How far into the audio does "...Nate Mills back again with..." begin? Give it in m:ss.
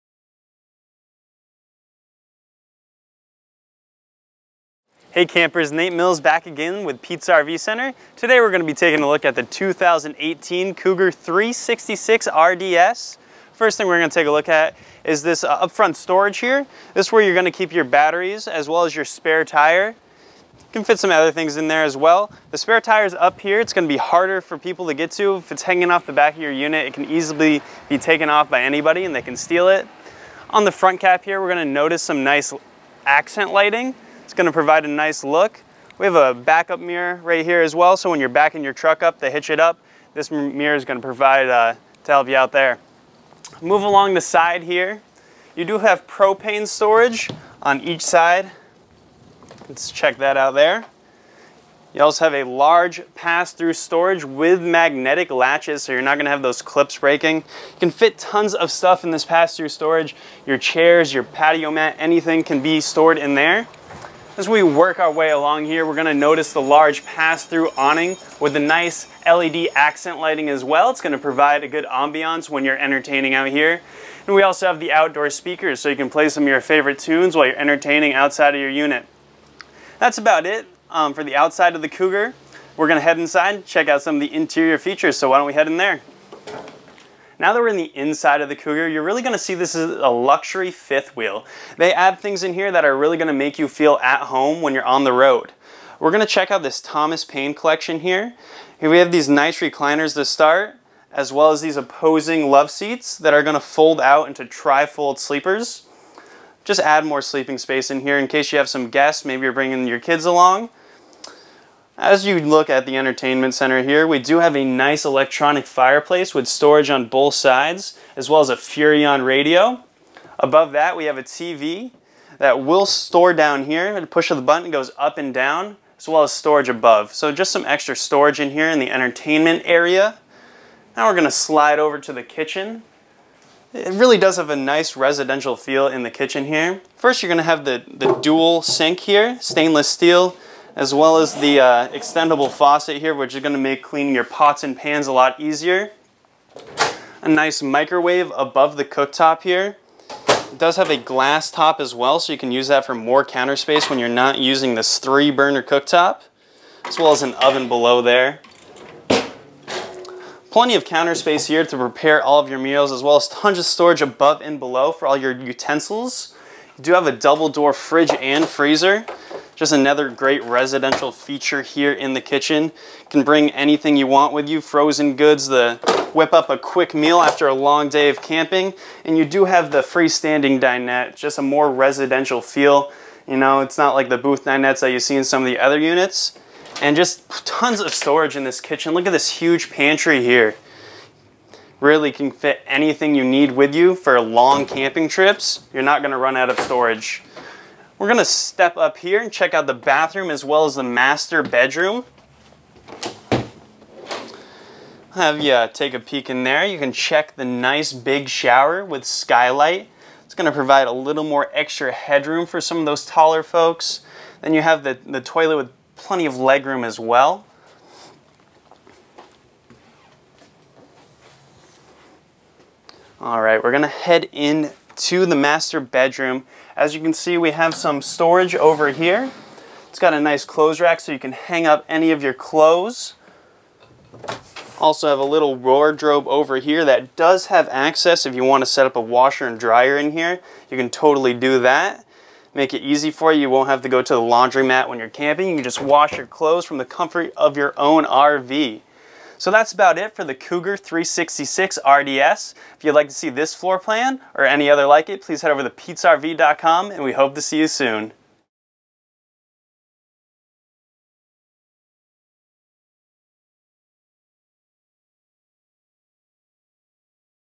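0:05.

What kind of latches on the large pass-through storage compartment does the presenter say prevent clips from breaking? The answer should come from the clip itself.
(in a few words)
Magnetic latches.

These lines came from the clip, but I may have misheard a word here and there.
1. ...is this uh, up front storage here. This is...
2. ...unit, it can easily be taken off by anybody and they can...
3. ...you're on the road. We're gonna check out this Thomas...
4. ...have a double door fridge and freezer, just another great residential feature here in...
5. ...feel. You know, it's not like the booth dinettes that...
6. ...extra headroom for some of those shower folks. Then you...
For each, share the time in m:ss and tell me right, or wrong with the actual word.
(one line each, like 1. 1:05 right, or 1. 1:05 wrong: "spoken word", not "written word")
1. 0:15 right
2. 0:26 right
3. 1:34 right
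4. 2:46 right
5. 3:02 right
6. 3:31 wrong: "taller", not "shower".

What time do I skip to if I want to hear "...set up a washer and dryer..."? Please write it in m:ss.
3:58.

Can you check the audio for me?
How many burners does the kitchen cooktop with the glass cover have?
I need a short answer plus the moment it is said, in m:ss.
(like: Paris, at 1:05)
3, at 2:34.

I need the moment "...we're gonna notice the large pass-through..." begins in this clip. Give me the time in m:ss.
1:05.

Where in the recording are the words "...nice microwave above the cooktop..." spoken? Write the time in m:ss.
2:27.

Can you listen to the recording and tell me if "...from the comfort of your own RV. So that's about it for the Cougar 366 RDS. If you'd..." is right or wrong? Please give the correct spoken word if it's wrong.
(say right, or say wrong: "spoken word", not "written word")
right.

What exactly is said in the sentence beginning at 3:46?
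As you can see, we have some storage over here.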